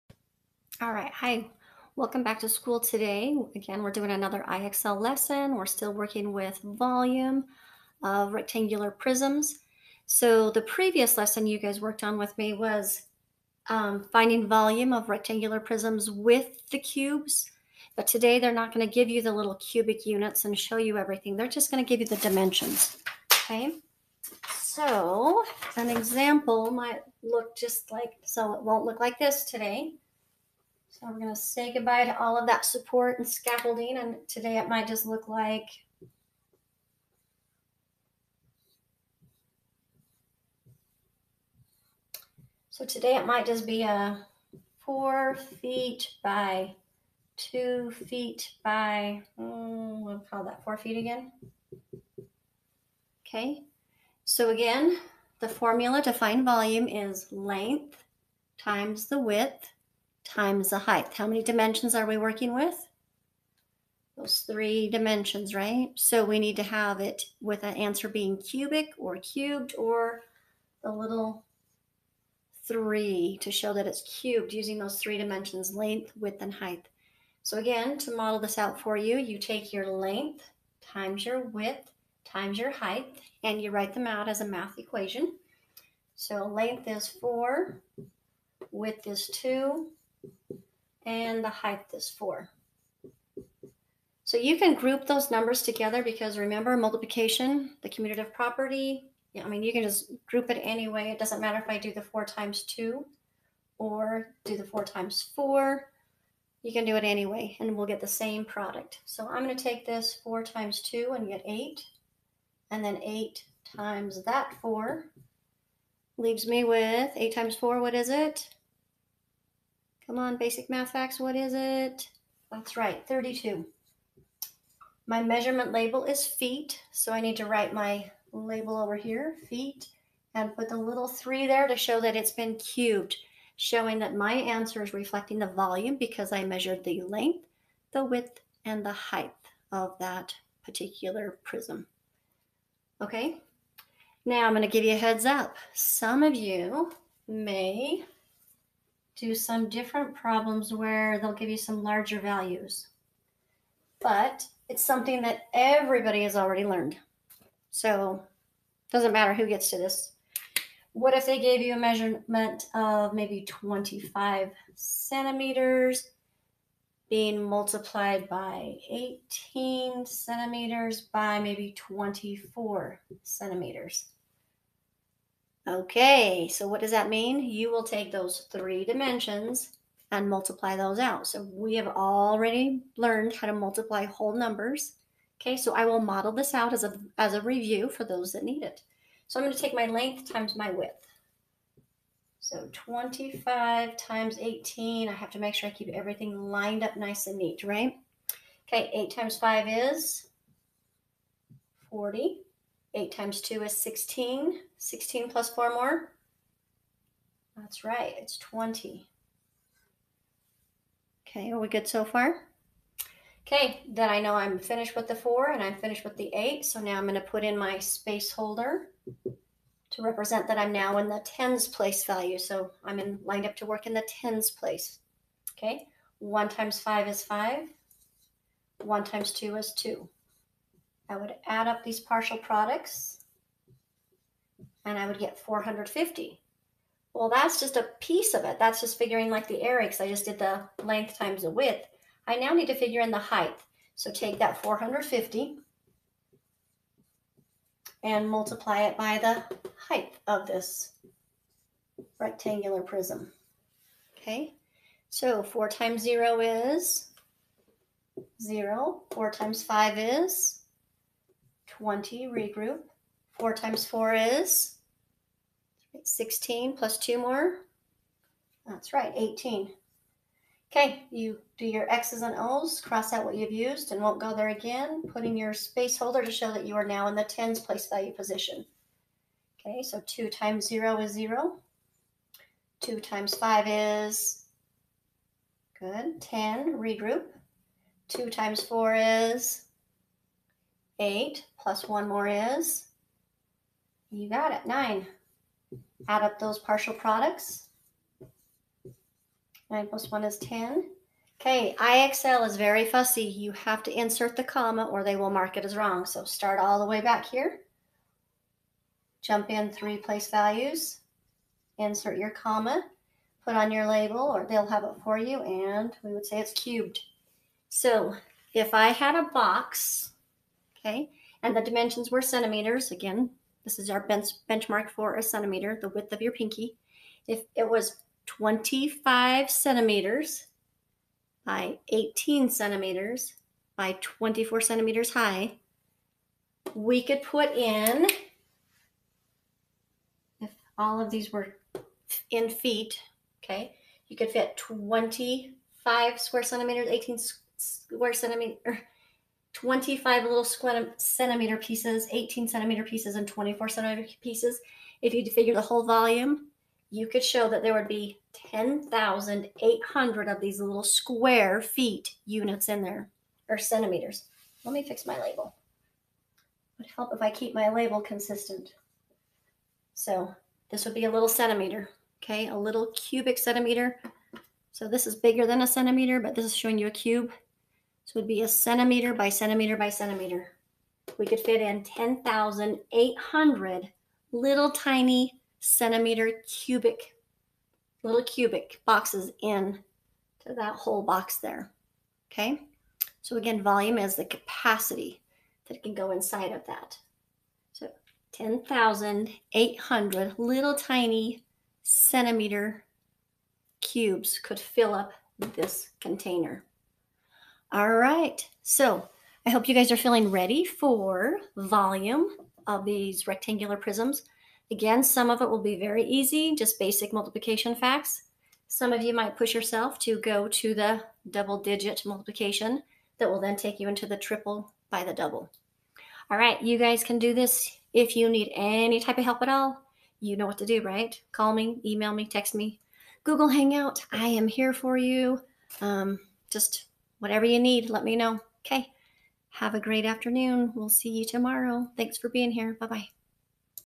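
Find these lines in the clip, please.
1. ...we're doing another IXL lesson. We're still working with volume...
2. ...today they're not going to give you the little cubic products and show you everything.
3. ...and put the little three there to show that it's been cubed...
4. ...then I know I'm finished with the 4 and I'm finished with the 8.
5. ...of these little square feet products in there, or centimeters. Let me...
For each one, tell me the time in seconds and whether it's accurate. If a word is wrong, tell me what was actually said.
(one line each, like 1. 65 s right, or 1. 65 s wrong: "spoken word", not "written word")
1. 3 s right
2. 18 s wrong: "units", not "products"
3. 130 s right
4. 213 s right
5. 360 s wrong: "units", not "products".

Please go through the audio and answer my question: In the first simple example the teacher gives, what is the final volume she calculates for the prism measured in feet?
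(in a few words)
32 cubic feet.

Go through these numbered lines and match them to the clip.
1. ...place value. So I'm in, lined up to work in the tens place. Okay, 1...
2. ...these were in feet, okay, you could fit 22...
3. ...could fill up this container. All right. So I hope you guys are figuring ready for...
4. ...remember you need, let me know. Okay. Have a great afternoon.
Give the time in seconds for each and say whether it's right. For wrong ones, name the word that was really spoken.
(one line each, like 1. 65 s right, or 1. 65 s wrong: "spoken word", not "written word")
1. 221 s right
2. 341 s wrong: "25", not "22"
3. 404 s wrong: "feeling", not "figuring"
4. 437 s wrong: "whatever", not "remember".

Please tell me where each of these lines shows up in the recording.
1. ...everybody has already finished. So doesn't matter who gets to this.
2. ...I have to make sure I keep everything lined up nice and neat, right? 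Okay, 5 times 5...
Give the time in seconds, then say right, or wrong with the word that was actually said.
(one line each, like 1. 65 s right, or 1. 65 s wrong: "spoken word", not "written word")
1. 155 s wrong: "learned", not "finished"
2. 195 s wrong: "8", not "5".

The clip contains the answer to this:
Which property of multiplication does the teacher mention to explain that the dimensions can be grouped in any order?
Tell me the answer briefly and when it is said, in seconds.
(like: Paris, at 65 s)
commutative property, at 97 s.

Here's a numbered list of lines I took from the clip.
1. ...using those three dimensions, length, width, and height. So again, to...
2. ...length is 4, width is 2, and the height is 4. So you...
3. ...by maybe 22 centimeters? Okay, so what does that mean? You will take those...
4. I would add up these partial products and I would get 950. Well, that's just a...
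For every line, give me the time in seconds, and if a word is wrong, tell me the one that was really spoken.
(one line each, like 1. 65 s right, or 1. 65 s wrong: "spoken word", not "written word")
1. 74 s right
2. 86 s right
3. 171 s wrong: "24", not "22"
4. 231 s wrong: "450", not "950".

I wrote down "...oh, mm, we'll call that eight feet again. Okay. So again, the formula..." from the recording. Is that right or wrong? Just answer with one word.
wrong.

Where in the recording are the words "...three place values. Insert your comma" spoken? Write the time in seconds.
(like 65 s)
309 s.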